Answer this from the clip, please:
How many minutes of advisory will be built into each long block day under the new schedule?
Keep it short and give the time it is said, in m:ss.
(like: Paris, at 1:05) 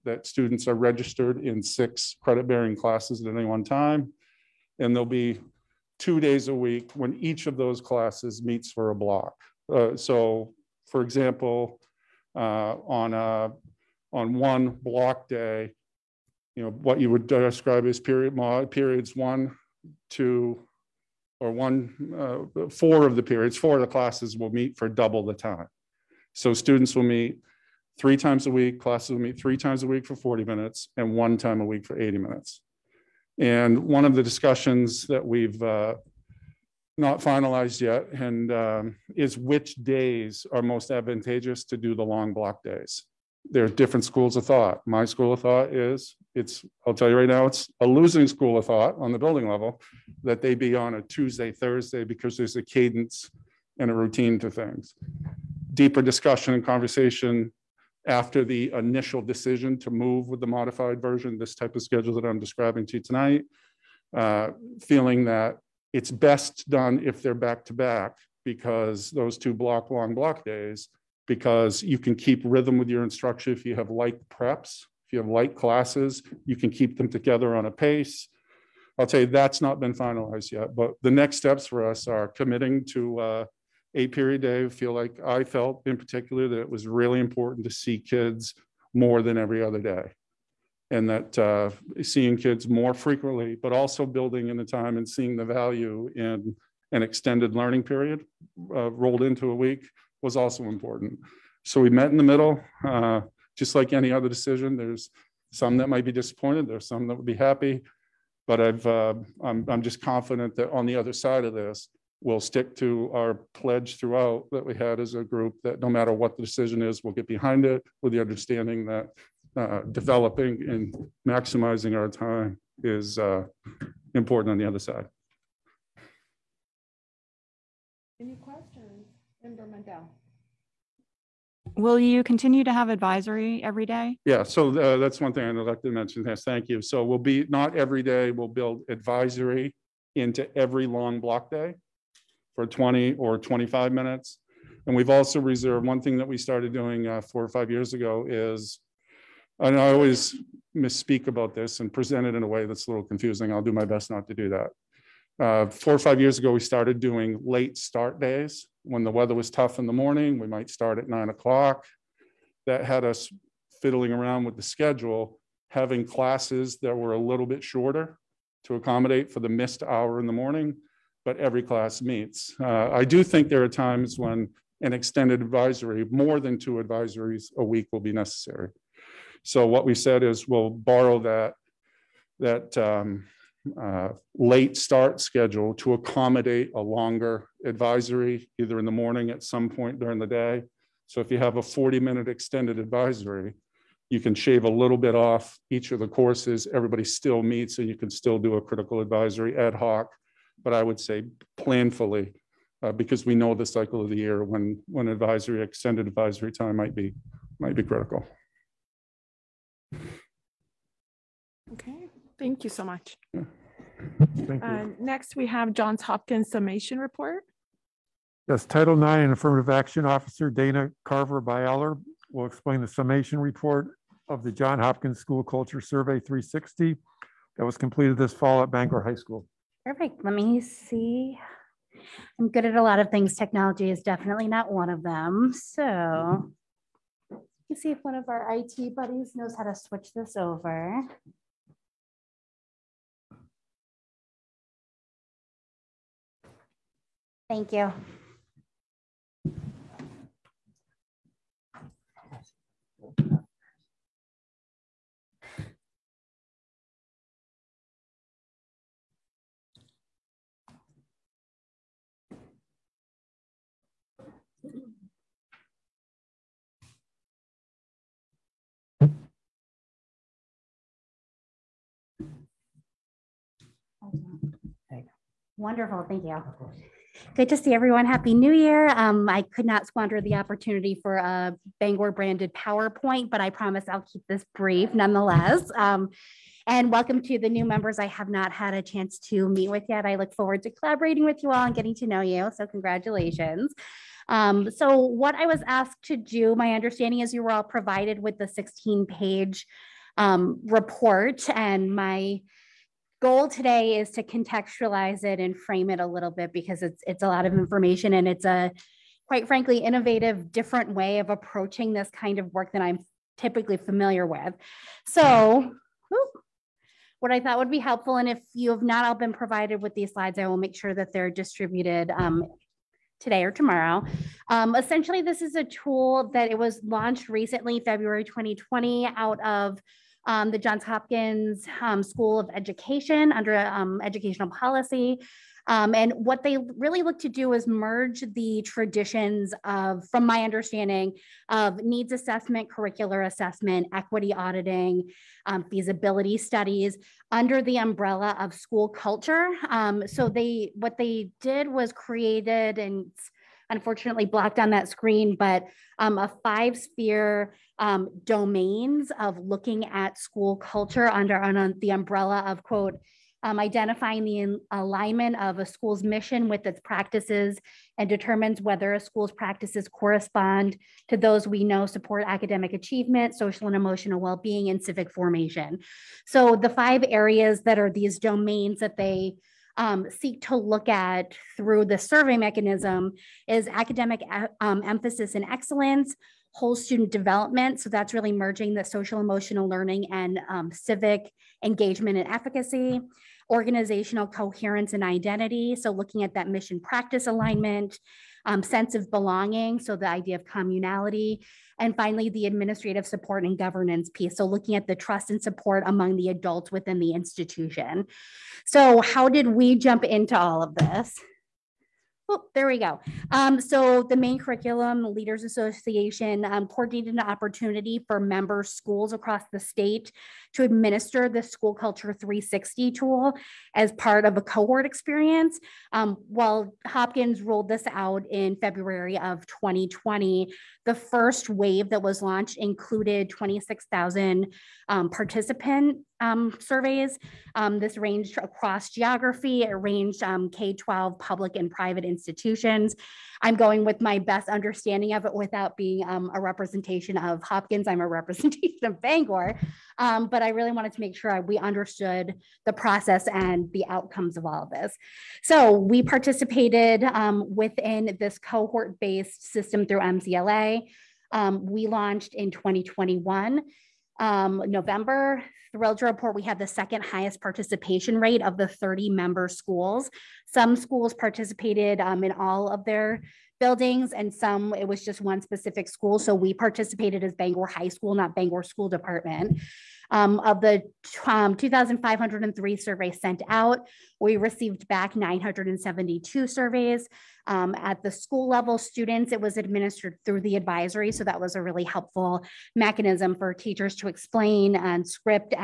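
20 or 25 minutes, at 2:22.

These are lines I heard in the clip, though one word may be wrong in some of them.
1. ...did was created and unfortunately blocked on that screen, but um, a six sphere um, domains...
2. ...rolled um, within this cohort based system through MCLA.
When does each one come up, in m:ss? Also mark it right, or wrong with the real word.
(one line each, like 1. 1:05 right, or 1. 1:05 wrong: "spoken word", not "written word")
1. 5:51 wrong: "five", not "six"
2. 7:36 wrong: "participated", not "rolled".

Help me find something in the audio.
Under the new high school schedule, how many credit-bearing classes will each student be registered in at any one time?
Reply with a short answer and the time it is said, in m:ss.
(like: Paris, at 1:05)
6, at 0:01.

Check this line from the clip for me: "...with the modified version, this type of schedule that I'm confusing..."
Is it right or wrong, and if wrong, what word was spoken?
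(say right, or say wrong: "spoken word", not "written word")
wrong: "describing", not "confusing".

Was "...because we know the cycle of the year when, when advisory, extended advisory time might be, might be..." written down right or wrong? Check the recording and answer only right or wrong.
right.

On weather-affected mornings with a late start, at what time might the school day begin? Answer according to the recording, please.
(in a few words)
9 o'clock.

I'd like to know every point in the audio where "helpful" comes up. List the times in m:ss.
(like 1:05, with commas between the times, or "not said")
5:17, 8:11.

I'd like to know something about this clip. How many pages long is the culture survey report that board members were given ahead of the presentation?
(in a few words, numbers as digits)
16.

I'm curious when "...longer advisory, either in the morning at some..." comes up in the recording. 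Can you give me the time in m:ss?
3:06.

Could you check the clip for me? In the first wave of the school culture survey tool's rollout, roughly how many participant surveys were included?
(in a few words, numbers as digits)
26,000.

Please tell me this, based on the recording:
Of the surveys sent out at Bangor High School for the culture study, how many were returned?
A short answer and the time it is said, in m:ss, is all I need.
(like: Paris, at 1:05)
972, at 8:05.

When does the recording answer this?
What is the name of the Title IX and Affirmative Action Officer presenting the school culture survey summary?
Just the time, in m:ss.
3:40.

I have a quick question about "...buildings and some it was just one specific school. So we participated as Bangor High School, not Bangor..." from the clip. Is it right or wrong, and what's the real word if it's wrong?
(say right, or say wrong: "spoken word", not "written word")
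right.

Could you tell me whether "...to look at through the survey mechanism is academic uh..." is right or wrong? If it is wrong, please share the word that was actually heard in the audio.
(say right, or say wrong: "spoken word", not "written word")
right.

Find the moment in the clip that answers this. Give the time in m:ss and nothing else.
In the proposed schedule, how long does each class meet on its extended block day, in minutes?
0:31.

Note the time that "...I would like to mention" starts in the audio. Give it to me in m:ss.
2:15.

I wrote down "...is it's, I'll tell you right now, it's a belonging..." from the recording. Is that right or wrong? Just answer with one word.
wrong.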